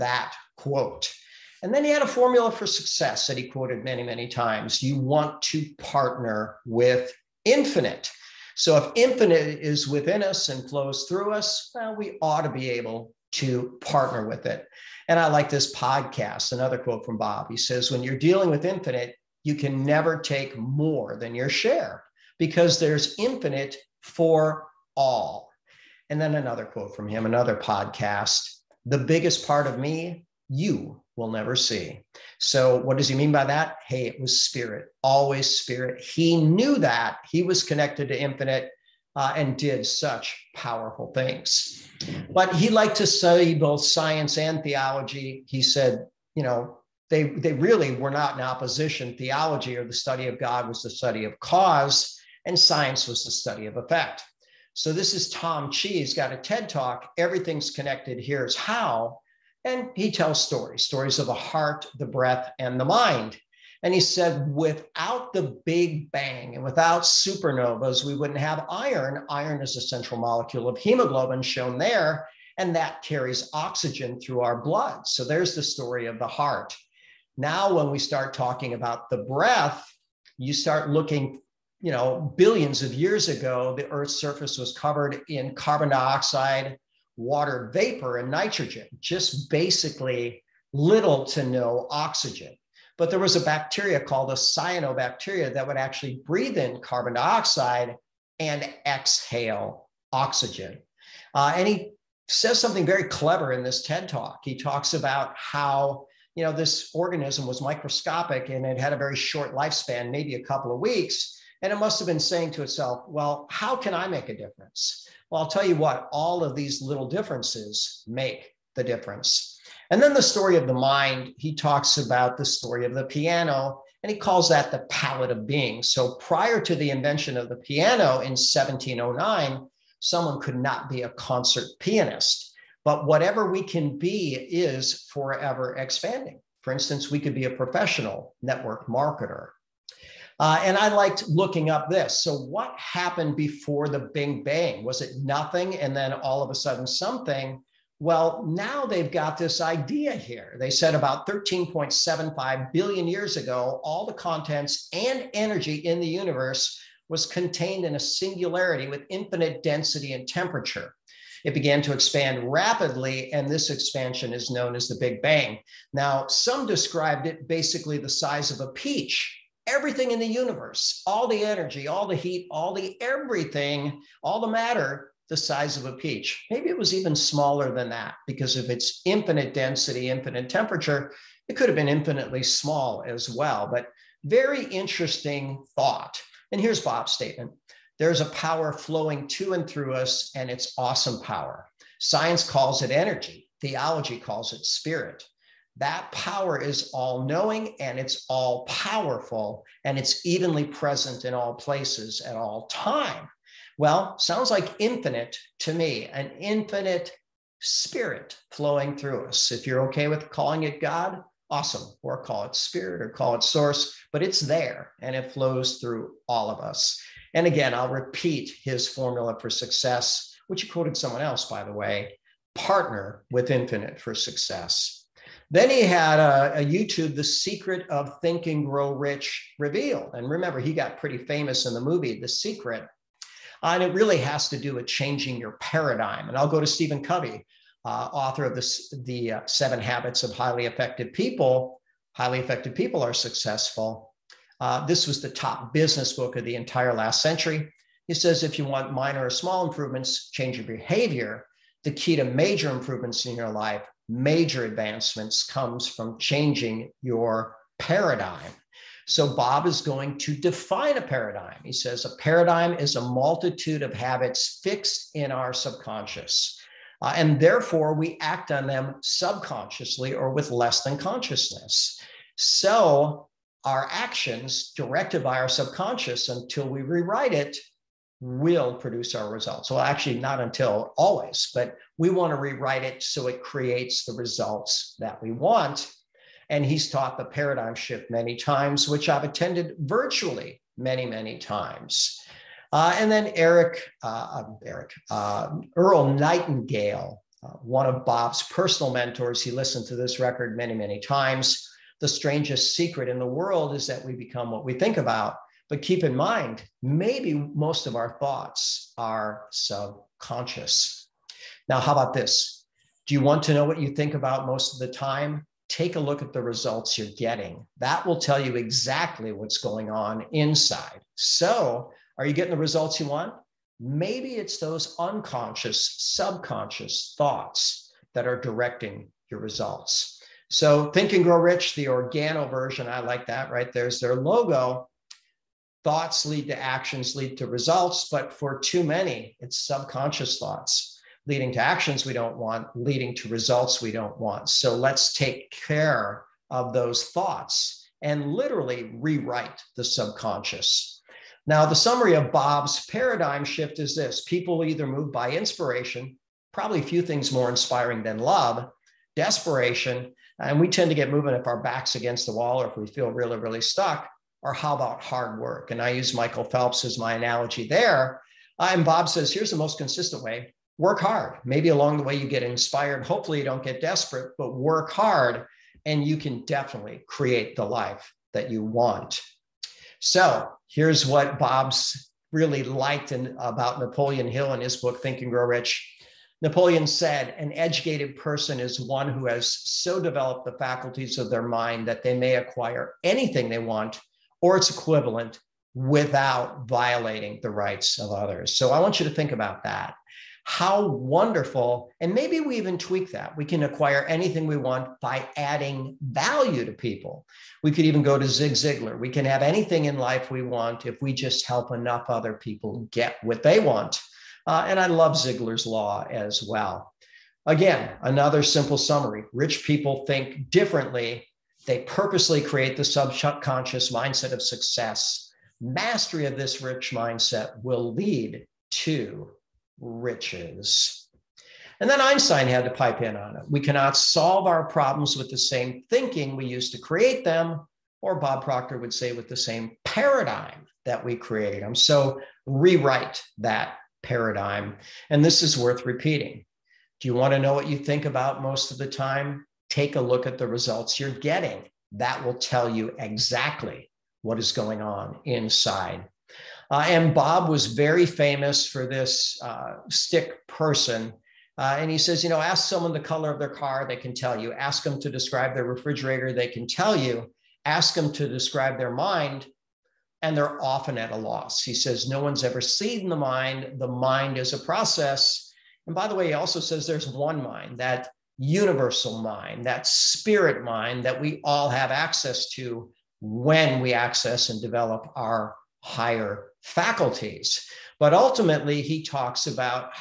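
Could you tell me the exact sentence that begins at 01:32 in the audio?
But there was a bacteria called a cyanobacteria that would actually breathe in carbon dioxide and exhale oxygen.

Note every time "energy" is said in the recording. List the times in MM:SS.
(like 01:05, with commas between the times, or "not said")
02:35, 02:51, 03:12.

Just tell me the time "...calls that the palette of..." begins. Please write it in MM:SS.
02:04.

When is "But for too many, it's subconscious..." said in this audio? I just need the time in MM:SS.
05:38.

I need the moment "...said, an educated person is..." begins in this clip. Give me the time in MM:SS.
06:26.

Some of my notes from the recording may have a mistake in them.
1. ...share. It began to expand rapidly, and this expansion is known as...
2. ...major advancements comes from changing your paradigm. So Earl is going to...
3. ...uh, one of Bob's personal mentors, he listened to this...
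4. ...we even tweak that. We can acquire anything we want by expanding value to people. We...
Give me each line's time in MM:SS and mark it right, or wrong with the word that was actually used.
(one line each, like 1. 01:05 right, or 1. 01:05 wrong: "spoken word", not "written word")
1. 02:40 wrong: "temperature", not "share"
2. 04:14 wrong: "Bob", not "Earl"
3. 04:57 right
4. 06:42 wrong: "adding", not "expanding".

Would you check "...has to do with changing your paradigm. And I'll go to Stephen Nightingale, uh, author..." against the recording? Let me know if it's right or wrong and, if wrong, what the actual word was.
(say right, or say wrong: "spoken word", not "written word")
wrong: "Covey", not "Nightingale".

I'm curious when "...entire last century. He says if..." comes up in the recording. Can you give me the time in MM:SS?
04:06.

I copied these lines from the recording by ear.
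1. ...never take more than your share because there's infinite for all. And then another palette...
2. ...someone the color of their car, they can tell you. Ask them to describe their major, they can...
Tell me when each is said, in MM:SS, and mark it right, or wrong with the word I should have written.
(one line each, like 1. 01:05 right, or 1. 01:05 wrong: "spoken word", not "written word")
1. 00:19 wrong: "quote", not "palette"
2. 07:42 wrong: "refrigerator", not "major".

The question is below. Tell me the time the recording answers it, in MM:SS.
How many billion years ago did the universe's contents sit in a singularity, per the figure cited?
02:31.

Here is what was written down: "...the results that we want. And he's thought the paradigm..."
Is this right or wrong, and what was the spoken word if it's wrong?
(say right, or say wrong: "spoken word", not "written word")
wrong: "taught", not "thought".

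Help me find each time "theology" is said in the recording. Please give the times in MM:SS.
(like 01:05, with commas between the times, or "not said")
00:44, 00:49, 03:13.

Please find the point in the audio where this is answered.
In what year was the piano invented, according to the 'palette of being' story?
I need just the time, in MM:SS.
02:08.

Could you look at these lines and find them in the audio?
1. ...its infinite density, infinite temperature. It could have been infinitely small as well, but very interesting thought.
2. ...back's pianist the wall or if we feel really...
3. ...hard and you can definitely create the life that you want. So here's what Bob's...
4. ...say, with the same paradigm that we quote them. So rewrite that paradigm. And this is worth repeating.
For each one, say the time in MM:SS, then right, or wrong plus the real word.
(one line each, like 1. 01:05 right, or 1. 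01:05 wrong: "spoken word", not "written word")
1. 02:58 right
2. 06:01 wrong: "against", not "pianist"
3. 06:14 right
4. 07:18 wrong: "create", not "quote".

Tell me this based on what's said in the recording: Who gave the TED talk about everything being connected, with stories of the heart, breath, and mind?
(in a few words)
Tom Chi.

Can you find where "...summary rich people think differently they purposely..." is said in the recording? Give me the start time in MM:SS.
06:58.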